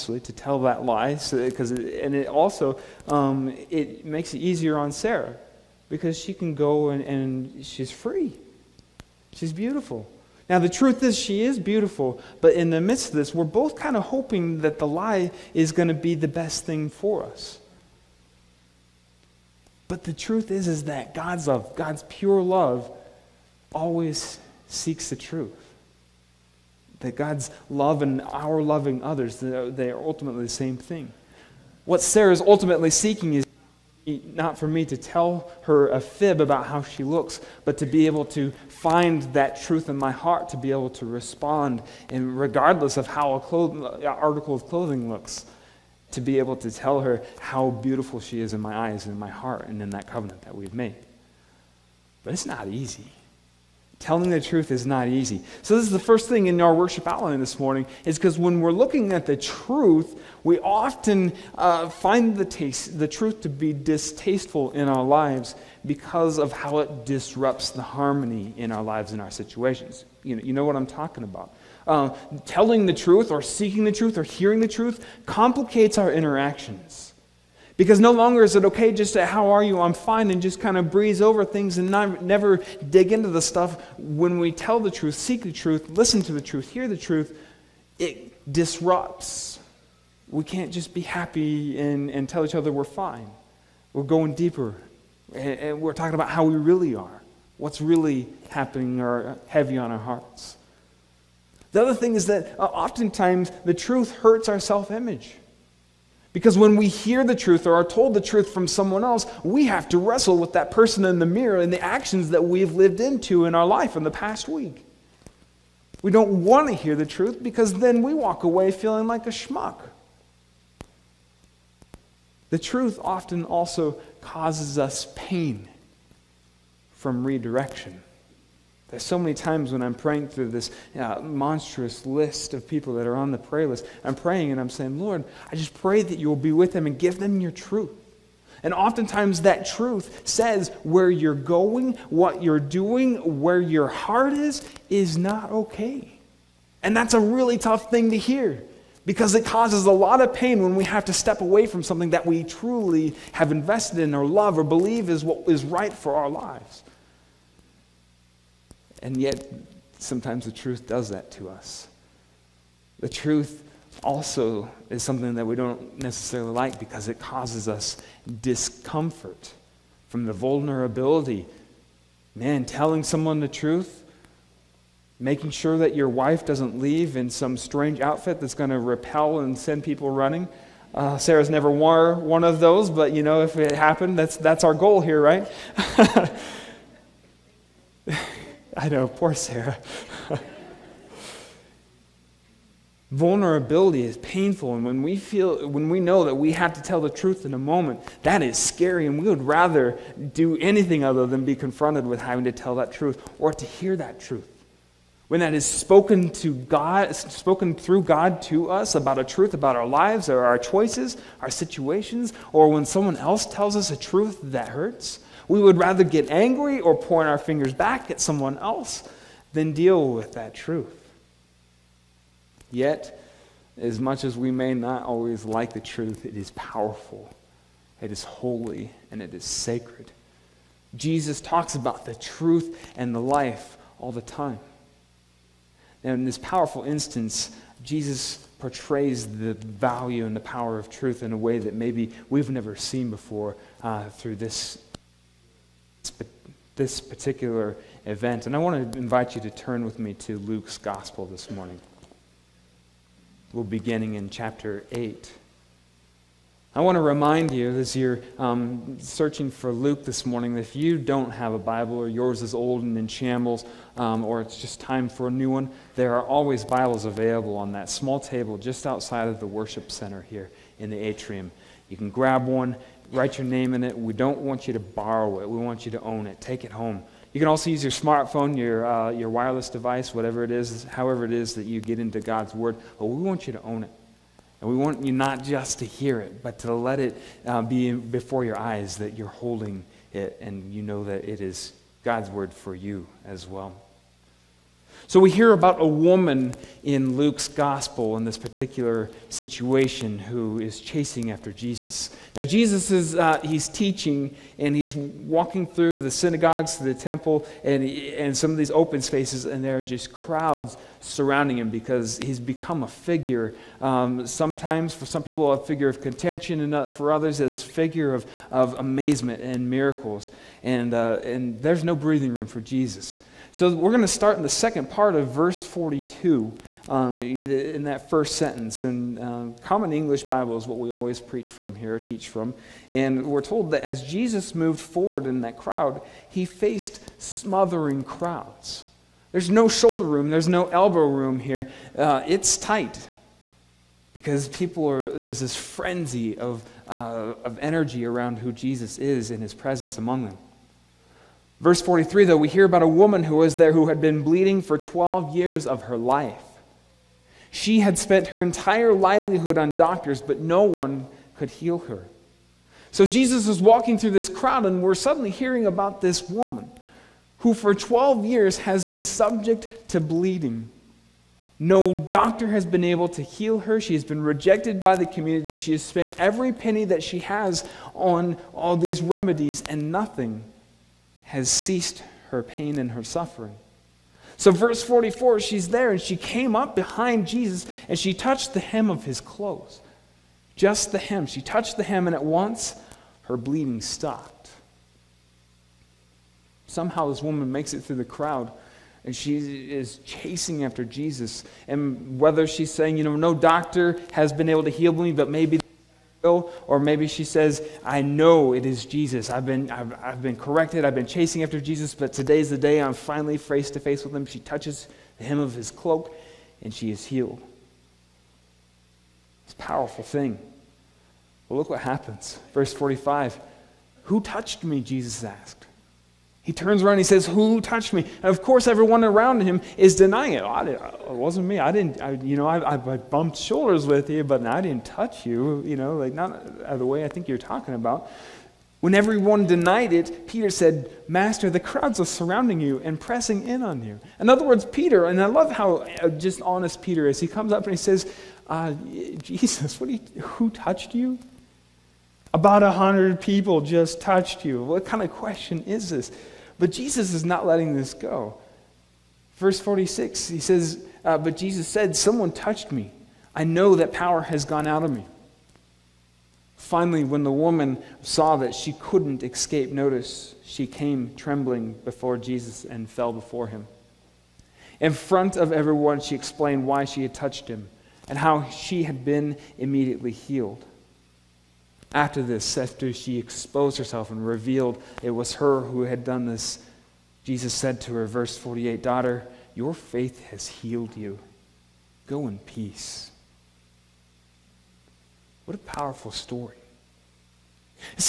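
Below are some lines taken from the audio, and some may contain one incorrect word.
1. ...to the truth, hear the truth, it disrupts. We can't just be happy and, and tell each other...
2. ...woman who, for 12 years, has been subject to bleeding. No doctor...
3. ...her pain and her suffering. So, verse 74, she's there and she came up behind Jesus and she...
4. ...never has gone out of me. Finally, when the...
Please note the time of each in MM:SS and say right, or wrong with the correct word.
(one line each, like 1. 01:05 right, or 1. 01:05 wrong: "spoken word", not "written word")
1. 01:26 right
2. 06:06 right
3. 06:22 wrong: "44", not "74"
4. 07:43 wrong: "power", not "never".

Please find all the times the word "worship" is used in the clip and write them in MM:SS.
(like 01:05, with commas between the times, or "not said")
00:56, 04:29.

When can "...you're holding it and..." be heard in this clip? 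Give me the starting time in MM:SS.
04:49.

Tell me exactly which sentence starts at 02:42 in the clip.
The truth also is something that we don't necessarily like because it causes us discomfort from the vulnerability.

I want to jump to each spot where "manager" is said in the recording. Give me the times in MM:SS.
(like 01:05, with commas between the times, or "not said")
not said.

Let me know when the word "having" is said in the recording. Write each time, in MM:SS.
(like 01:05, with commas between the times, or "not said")
03:22.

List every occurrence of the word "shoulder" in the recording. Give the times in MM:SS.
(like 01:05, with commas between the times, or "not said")
05:39, 07:13.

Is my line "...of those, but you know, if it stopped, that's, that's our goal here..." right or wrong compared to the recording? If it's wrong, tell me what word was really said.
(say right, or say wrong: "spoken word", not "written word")
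wrong: "happened", not "stopped".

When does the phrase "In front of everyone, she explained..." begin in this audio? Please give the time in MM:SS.
07:54.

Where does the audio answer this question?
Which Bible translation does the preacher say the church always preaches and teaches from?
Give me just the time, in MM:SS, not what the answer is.
05:29.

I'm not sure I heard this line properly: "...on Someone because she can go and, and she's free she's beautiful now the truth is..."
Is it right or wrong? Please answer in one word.
wrong.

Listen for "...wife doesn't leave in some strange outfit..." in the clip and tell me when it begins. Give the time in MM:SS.
02:56.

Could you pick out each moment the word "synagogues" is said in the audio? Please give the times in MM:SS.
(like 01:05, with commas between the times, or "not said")
05:06.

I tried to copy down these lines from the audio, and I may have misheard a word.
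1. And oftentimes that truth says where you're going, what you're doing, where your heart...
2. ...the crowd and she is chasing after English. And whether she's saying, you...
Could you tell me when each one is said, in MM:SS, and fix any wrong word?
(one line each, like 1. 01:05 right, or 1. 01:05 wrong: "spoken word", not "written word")
1. 02:18 right
2. 06:37 wrong: "Jesus", not "English".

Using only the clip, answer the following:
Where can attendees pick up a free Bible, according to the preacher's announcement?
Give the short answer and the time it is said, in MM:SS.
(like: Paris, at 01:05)
The atrium, at 04:30.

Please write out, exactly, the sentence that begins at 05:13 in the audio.
Um, sometimes for some people a figure of contention and uh, for others as figure of, of amazement and miracles.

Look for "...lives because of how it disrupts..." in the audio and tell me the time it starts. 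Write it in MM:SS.
01:05.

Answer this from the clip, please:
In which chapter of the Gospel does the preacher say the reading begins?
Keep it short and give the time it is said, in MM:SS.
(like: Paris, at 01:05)
Chapter 8, at 04:14.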